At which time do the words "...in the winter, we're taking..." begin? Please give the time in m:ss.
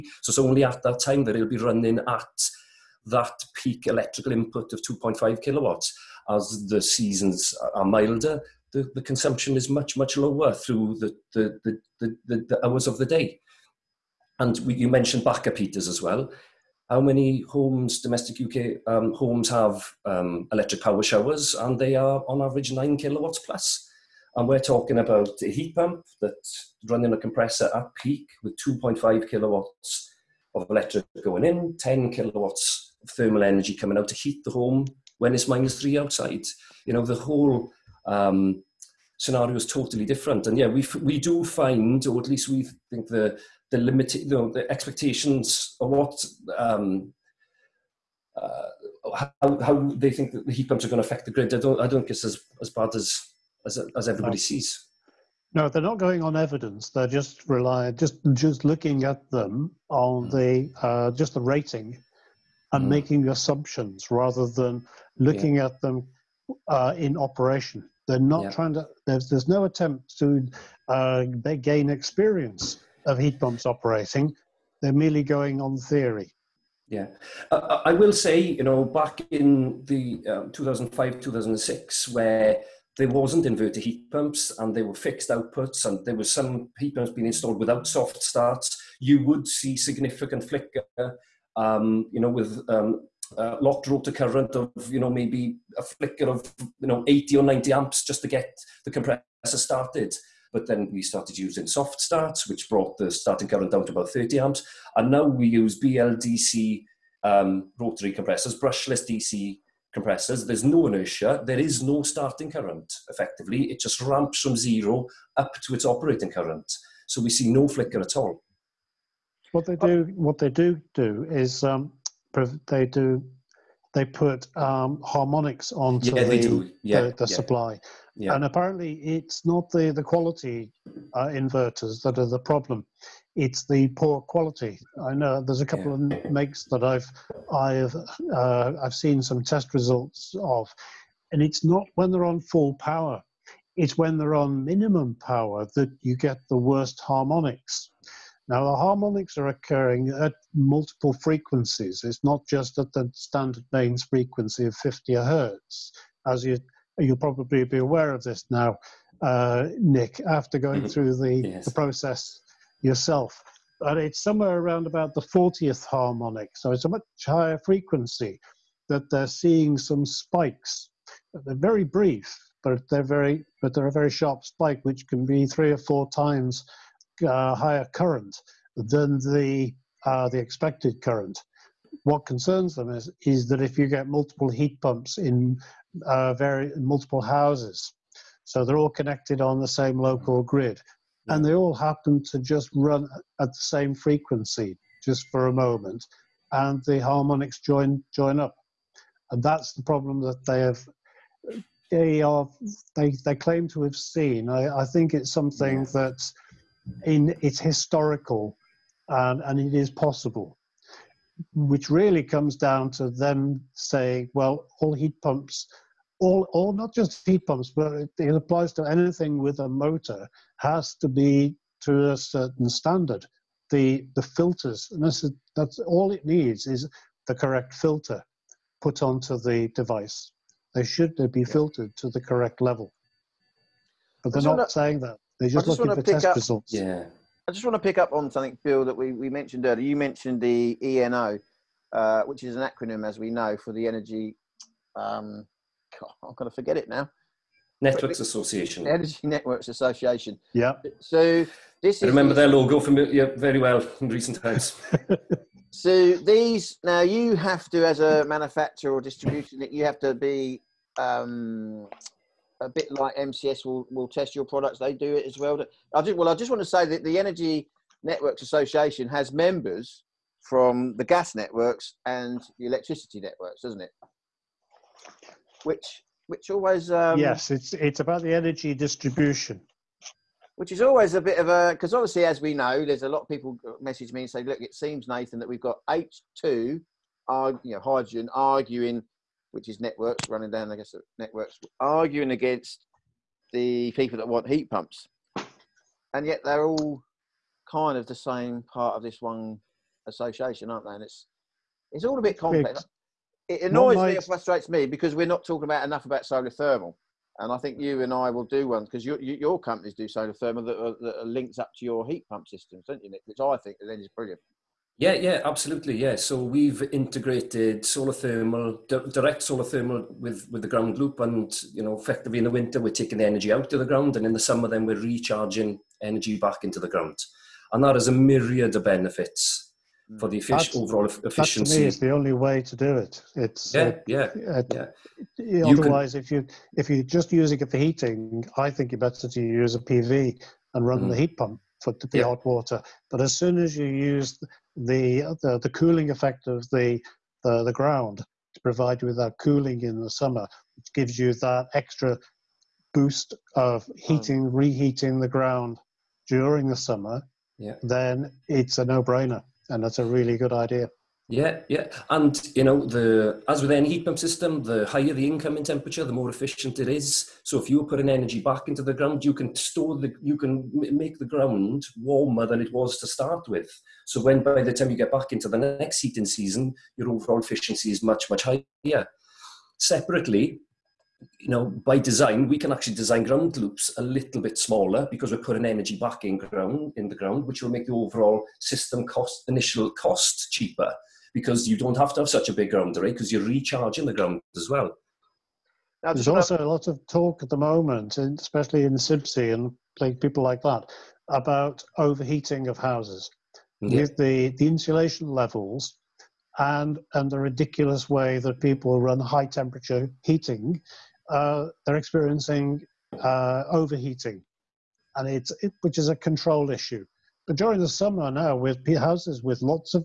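5:22.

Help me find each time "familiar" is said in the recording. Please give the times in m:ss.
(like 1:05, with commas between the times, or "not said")
4:12.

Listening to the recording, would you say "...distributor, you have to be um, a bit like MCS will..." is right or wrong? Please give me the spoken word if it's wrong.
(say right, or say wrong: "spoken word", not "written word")
right.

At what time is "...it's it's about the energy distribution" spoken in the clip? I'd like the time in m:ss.
4:37.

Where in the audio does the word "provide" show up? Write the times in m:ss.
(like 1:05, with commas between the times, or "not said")
5:48.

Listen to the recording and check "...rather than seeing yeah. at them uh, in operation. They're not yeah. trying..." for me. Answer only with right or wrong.
wrong.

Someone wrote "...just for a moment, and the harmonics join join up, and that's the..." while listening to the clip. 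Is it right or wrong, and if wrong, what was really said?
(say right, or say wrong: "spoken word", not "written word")
right.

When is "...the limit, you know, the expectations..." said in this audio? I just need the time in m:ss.
0:43.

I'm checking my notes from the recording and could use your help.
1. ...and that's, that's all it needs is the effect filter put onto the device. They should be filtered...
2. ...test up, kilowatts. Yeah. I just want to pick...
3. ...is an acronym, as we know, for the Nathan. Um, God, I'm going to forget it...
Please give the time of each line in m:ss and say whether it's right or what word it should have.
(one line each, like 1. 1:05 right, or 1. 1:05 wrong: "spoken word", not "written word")
1. 3:44 wrong: "correct", not "effect"
2. 3:56 wrong: "results", not "kilowatts"
3. 4:02 wrong: "Energy", not "Nathan".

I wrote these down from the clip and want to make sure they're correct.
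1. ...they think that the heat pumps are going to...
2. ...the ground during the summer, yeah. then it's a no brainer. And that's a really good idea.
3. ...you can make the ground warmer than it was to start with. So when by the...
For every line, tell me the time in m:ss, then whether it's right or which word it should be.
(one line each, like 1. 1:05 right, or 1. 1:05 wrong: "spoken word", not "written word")
1. 0:49 right
2. 5:55 right
3. 6:10 right.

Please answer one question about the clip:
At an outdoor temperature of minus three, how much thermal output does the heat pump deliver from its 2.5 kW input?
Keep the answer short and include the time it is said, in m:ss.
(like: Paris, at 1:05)
10 kilowatts, at 0:31.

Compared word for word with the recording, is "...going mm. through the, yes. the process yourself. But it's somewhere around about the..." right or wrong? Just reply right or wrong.
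right.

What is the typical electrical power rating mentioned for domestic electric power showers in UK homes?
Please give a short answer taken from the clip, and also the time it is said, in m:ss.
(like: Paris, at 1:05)
9 kilowatts, at 0:22.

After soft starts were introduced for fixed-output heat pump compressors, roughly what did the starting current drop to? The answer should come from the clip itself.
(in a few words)
30 amps.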